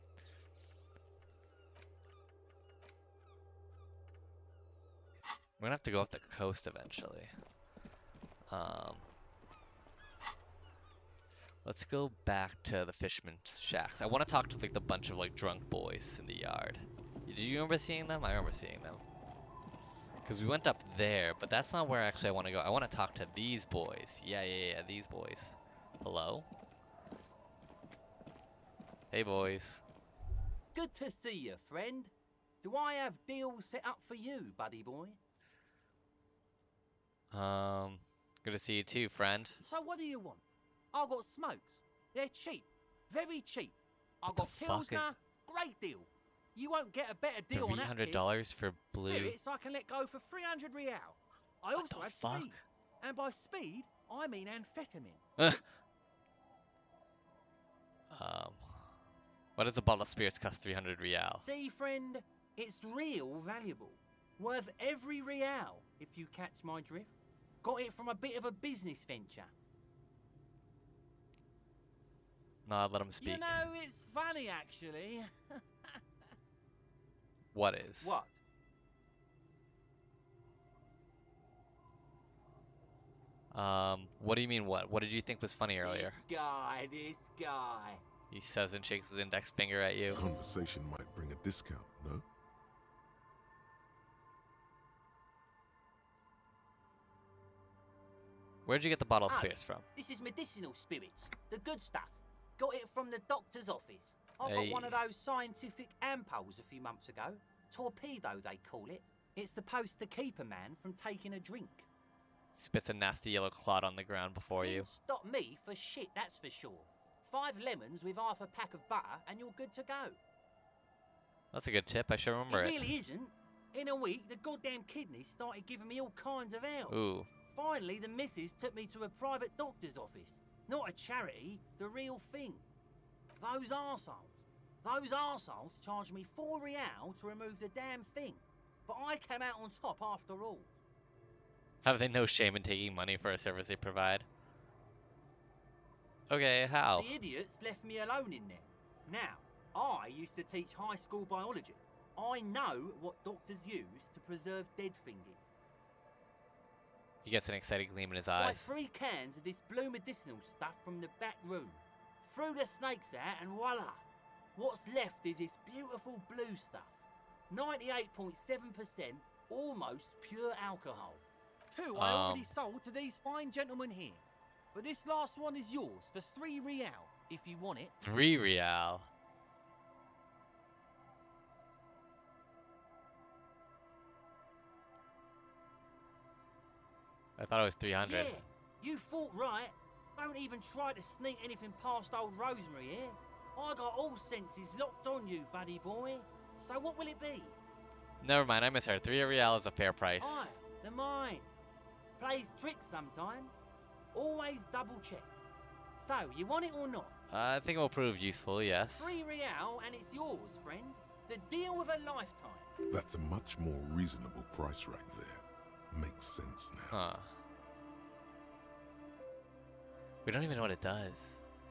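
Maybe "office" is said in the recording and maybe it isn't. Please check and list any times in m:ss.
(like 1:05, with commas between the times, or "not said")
1:43, 2:09.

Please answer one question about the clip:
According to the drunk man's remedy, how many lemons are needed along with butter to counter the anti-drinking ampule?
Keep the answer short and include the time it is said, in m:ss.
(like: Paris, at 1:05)
5, at 1:57.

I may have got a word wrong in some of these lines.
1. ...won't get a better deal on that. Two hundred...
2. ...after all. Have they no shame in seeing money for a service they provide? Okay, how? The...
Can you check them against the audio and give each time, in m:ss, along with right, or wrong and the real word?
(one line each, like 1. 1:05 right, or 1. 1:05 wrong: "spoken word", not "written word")
1. 0:46 wrong: "Three", not "Two"
2. 2:20 wrong: "taking", not "seeing".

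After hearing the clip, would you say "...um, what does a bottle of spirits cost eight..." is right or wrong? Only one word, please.
wrong.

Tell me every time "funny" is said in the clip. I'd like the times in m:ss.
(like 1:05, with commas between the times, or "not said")
1:14, 1:25.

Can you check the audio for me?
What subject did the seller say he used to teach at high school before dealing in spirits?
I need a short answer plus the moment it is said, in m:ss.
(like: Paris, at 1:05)
Biology, at 2:31.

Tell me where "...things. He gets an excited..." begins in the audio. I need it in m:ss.
2:35.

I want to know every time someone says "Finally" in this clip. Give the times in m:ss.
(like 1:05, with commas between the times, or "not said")
2:07.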